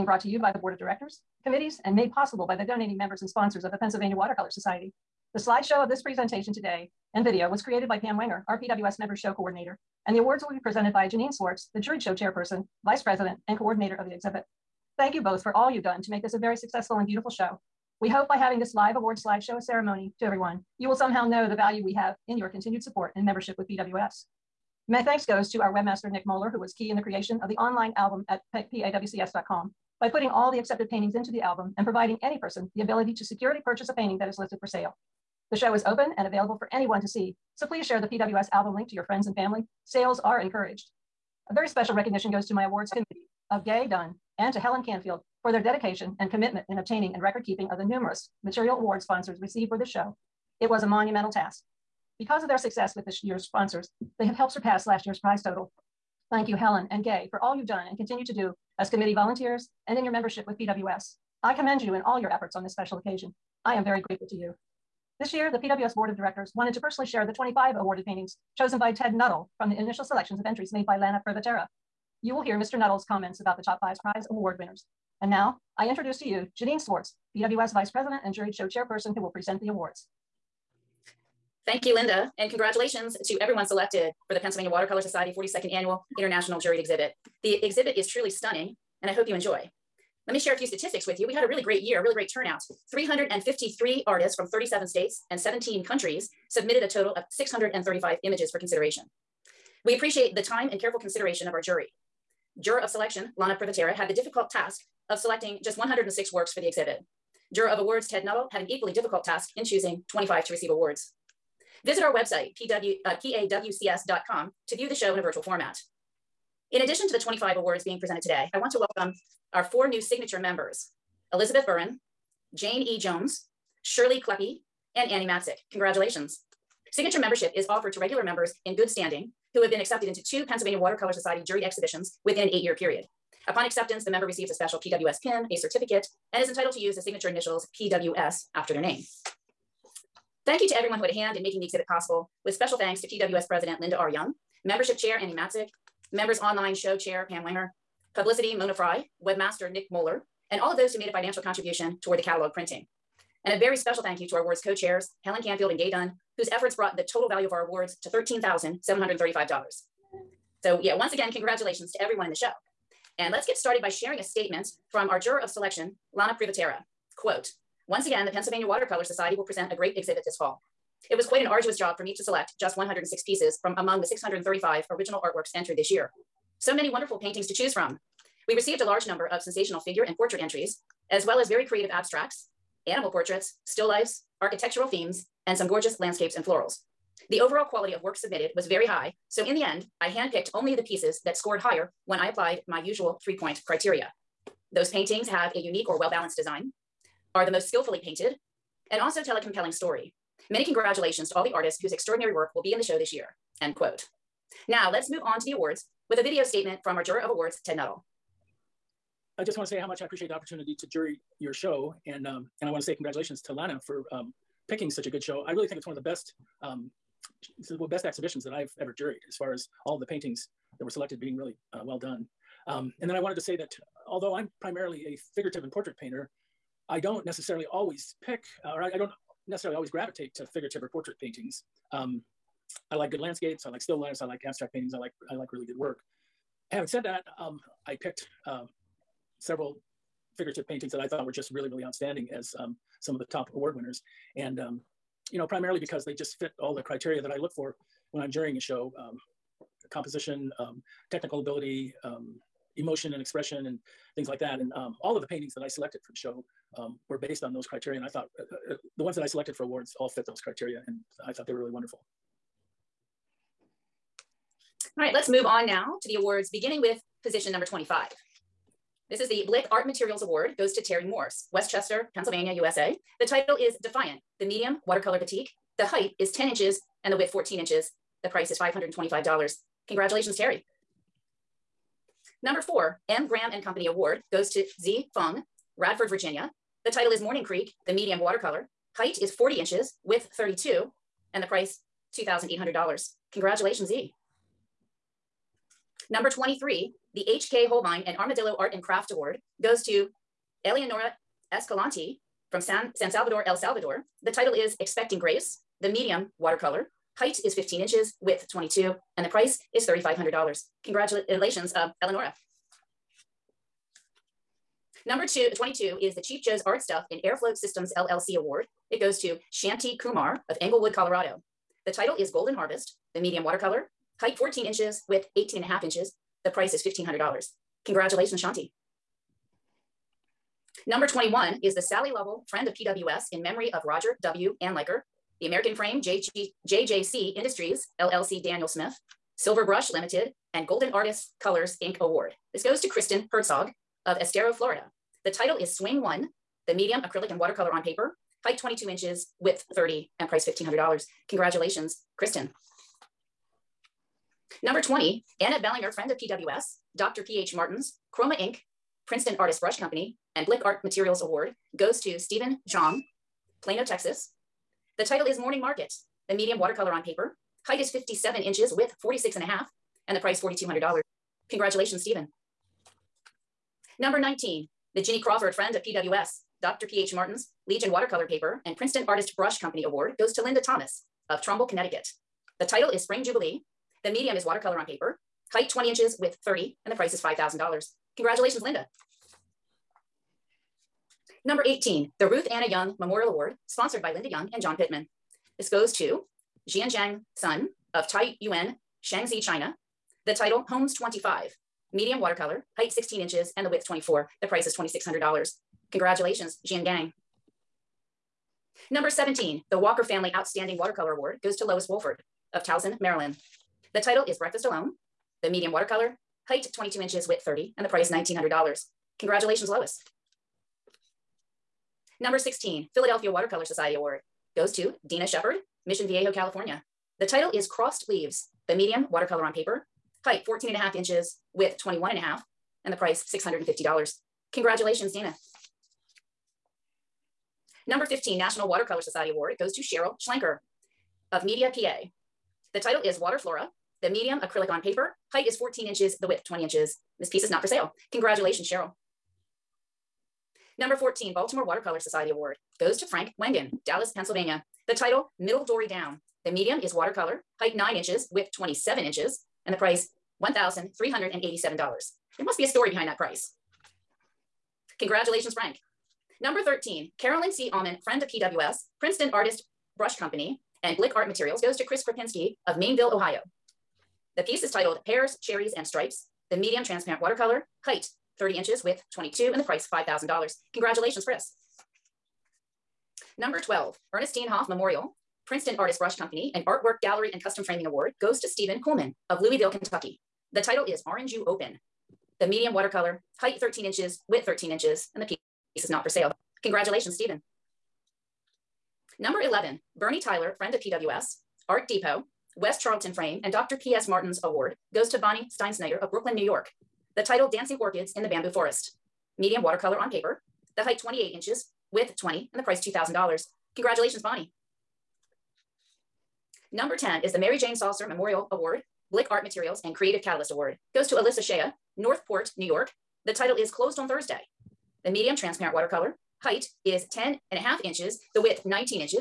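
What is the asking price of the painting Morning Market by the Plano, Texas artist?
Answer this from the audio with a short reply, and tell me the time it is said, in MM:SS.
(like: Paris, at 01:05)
$4,200, at 06:10.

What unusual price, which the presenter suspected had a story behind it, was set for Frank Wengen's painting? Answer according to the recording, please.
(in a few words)
$1,387.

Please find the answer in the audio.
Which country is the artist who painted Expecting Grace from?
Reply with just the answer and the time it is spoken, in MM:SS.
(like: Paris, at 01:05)
El Salvador, at 05:03.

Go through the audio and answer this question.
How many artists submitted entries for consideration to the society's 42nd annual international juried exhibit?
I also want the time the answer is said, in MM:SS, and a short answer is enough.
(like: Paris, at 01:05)
353, at 01:32.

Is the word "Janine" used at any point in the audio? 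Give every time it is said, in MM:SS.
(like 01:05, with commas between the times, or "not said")
00:11, 01:16.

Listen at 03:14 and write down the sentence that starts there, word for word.
Those paintings have a unique or well-balanced design, are the most skillfully painted, and also tell a compelling story.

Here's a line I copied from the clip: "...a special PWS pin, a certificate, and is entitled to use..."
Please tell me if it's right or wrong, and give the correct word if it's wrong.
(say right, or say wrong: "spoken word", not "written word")
right.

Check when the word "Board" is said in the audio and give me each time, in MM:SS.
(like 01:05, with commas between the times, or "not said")
00:00, 01:05.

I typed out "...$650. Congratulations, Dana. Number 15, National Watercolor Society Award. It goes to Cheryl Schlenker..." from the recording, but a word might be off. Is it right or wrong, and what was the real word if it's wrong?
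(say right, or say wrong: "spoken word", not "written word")
right.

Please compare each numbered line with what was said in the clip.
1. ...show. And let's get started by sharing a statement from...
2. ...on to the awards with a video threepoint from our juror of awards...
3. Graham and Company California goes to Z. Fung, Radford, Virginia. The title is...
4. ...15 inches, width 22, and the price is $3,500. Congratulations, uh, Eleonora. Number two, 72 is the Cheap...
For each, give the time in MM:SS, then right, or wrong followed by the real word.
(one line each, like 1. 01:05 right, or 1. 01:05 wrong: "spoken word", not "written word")
1. 02:42 right
2. 03:25 wrong: "statement", not "threepoint"
3. 04:43 wrong: "Award", not "California"
4. 05:07 wrong: "22", not "72".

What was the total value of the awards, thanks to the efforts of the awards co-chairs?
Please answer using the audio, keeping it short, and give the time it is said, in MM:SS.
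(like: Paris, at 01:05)
$13,735, at 02:38.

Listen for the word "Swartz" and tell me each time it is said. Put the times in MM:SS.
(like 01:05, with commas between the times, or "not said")
00:11, 01:16.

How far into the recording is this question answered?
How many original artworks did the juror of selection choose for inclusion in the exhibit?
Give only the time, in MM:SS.
01:45.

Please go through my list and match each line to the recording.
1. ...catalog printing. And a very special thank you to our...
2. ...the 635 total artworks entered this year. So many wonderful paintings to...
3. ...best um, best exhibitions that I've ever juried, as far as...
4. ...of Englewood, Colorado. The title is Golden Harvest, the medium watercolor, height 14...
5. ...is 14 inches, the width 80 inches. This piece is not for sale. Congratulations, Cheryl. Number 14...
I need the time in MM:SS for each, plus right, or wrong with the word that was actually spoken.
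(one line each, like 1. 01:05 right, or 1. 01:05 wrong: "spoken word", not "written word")
1. 02:32 right
2. 02:53 wrong: "original", not "total"
3. 03:35 right
4. 05:20 right
5. 07:25 wrong: "20", not "80".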